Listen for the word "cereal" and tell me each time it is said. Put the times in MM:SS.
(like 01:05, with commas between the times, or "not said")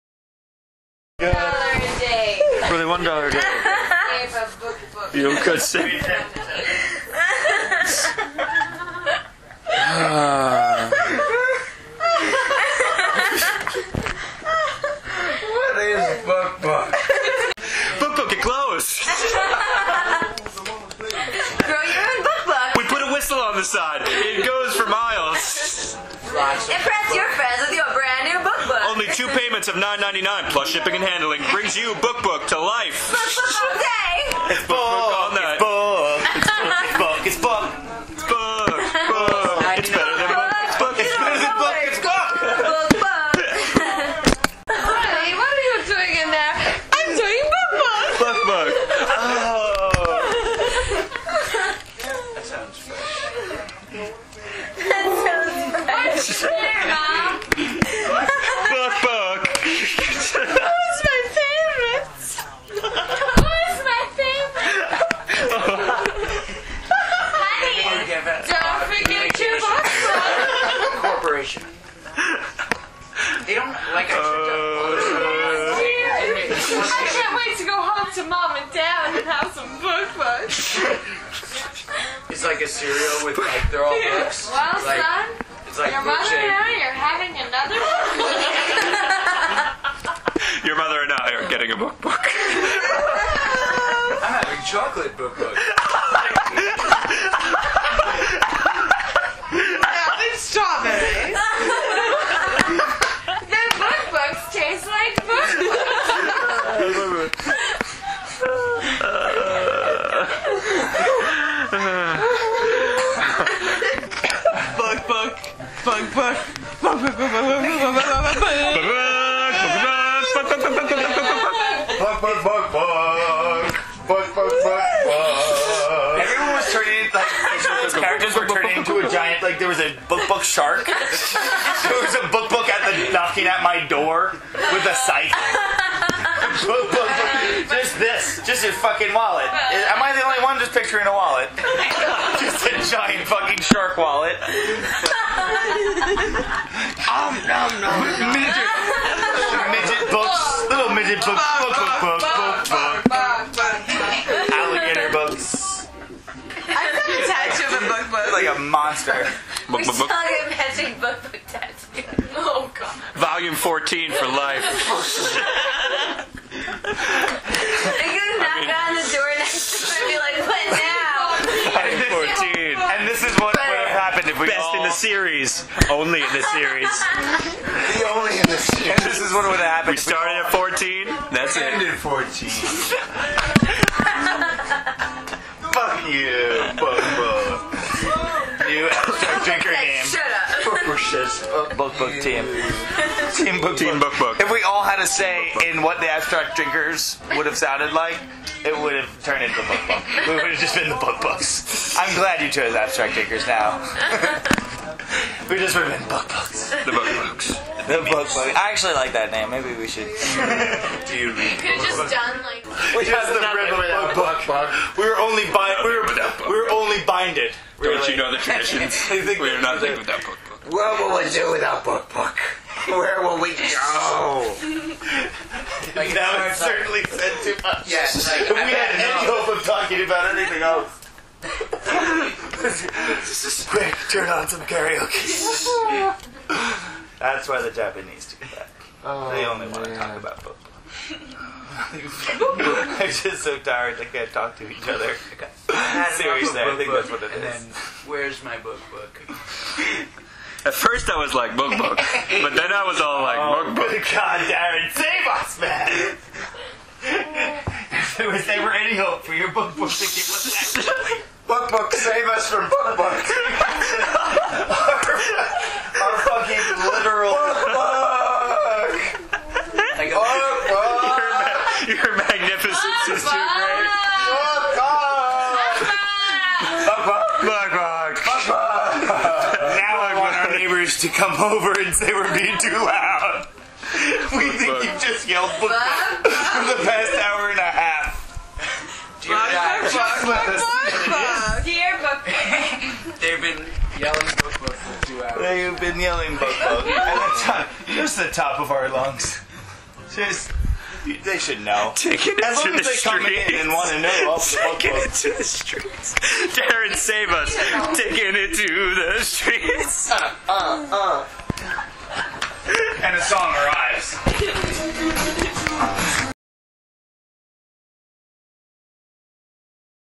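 01:22.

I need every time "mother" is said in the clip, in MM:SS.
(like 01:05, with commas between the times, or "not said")
01:26, 01:30.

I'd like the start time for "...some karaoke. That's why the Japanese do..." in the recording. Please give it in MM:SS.
03:54.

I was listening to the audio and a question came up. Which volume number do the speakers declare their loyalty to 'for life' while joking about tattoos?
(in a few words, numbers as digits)
14.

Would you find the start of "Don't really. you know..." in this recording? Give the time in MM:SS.
03:37.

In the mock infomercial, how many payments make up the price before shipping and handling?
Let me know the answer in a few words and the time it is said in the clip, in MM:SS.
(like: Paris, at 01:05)
2, at 00:29.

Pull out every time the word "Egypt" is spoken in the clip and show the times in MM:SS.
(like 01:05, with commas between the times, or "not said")
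not said.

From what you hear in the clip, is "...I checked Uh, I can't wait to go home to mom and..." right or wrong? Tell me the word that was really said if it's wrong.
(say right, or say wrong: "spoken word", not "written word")
right.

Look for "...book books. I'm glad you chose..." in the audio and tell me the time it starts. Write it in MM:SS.
03:20.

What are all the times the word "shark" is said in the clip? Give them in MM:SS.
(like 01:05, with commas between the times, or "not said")
02:10, 02:23.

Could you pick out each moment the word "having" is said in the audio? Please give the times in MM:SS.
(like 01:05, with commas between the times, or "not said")
01:26, 01:34.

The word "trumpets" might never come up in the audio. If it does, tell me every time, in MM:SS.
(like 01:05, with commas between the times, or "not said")
not said.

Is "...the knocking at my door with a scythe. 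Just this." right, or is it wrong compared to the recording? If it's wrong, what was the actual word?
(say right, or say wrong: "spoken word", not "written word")
right.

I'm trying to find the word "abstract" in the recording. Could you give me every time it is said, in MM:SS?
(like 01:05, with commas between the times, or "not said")
03:16, 03:22.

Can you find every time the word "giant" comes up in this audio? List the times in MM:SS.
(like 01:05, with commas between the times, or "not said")
02:09, 02:22.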